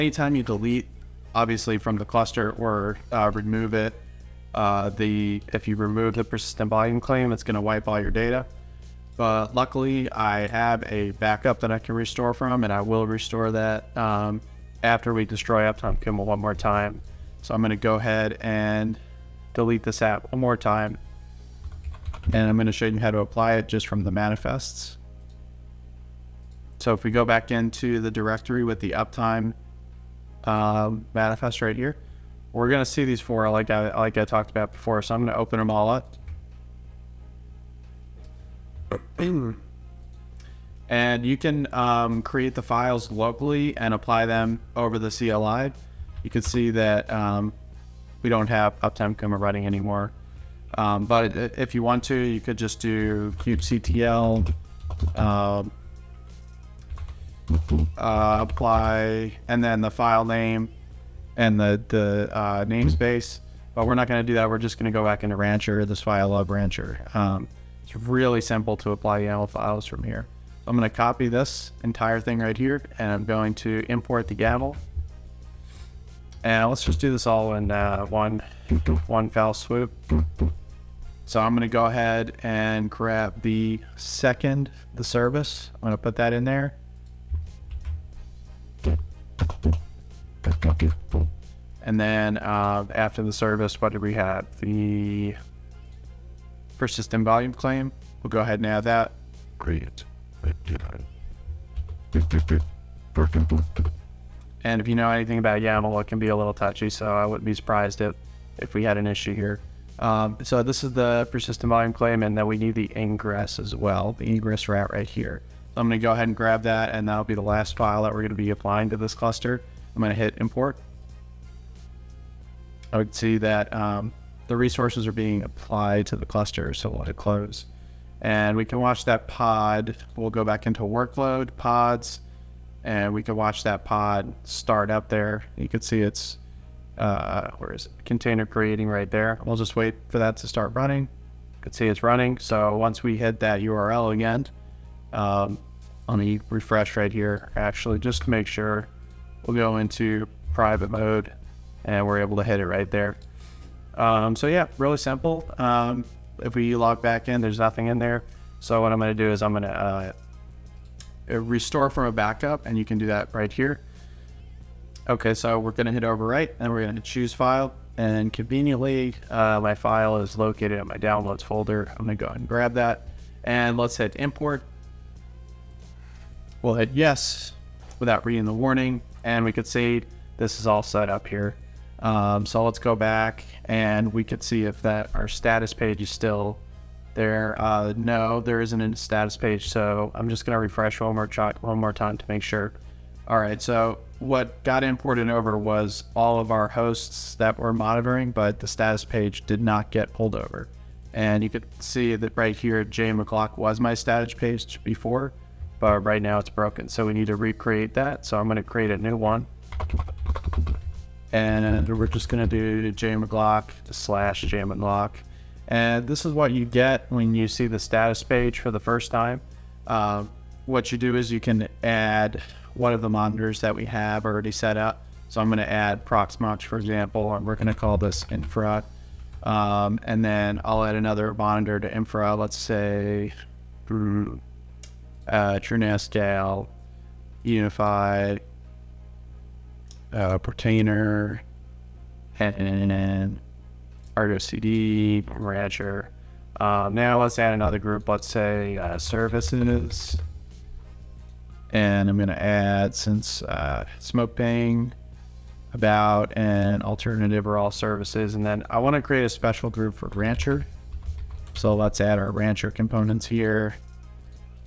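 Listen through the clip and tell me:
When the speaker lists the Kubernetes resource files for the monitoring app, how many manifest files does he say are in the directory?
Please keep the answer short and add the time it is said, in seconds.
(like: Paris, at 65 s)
4, at 33 s.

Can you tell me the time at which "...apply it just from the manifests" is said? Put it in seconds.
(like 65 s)
23 s.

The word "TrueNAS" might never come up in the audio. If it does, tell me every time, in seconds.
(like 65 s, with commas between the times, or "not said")
235 s.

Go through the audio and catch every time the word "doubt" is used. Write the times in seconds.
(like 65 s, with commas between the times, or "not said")
not said.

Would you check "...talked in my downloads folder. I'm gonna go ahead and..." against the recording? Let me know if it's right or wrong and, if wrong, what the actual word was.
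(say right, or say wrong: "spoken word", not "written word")
wrong: "located", not "talked".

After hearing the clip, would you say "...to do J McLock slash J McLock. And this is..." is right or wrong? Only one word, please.
right.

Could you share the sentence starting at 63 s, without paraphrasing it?
But we're not going to do that.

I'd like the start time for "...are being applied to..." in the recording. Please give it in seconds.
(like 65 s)
125 s.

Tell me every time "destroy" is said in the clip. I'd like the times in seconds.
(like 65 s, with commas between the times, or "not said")
15 s.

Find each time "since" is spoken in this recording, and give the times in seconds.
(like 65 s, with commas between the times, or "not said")
252 s.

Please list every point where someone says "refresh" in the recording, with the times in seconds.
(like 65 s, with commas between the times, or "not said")
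146 s, 190 s.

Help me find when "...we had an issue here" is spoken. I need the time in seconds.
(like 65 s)
108 s.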